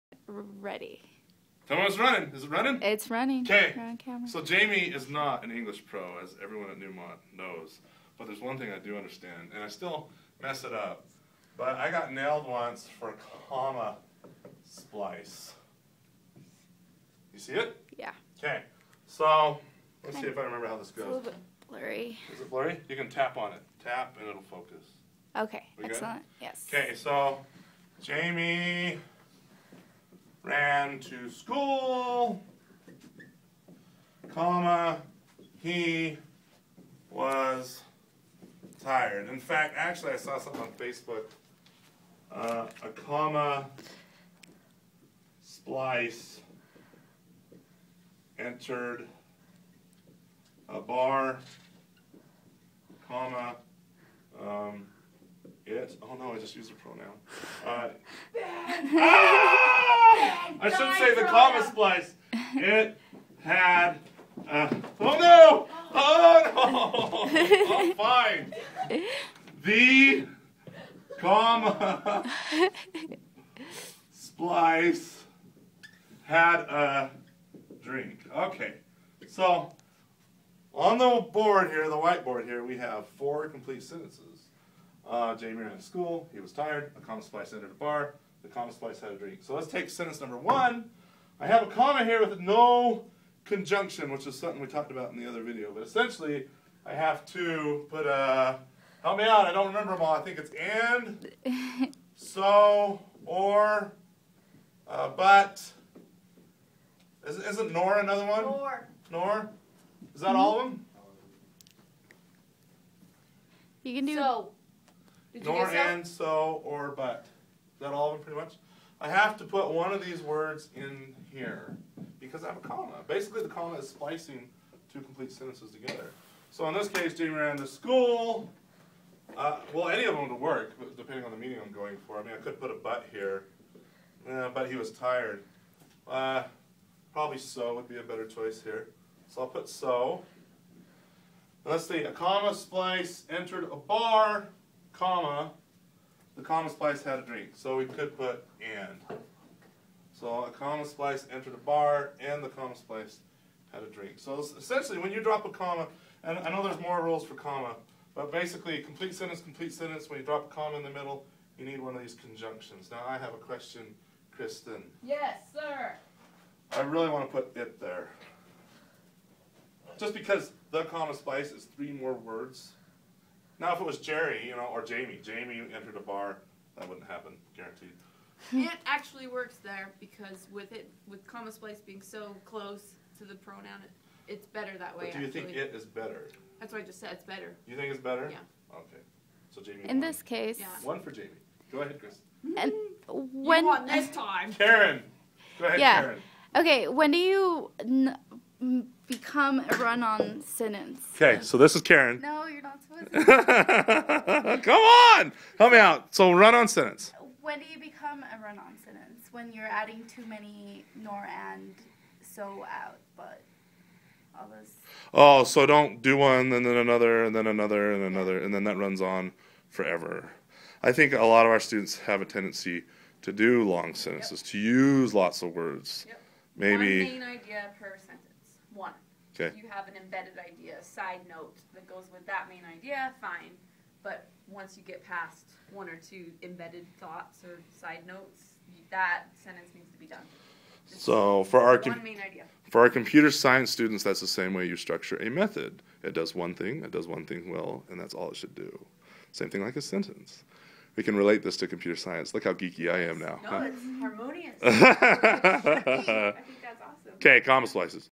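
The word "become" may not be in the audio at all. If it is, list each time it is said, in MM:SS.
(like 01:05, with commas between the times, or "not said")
03:19, 03:27.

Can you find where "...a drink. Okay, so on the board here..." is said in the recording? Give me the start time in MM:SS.
01:16.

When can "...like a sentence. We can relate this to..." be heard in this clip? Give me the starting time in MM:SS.
04:09.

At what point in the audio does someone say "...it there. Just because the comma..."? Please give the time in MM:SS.
02:47.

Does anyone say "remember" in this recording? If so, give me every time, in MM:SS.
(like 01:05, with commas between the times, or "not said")
00:20, 01:39.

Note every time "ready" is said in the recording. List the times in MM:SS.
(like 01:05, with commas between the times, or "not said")
00:00.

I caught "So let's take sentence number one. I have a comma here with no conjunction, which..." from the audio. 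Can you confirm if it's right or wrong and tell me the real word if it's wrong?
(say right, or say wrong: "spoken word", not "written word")
right.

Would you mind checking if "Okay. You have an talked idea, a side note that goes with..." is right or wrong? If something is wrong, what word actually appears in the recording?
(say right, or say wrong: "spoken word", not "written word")
wrong: "embedded", not "talked".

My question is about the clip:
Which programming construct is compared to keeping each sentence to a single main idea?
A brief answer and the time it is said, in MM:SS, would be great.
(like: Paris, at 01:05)
a method, at 04:05.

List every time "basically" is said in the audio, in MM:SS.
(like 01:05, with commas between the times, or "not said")
02:03, 02:38.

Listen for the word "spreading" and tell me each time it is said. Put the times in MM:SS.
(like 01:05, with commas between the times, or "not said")
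not said.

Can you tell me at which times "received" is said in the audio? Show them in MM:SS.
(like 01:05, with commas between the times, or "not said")
not said.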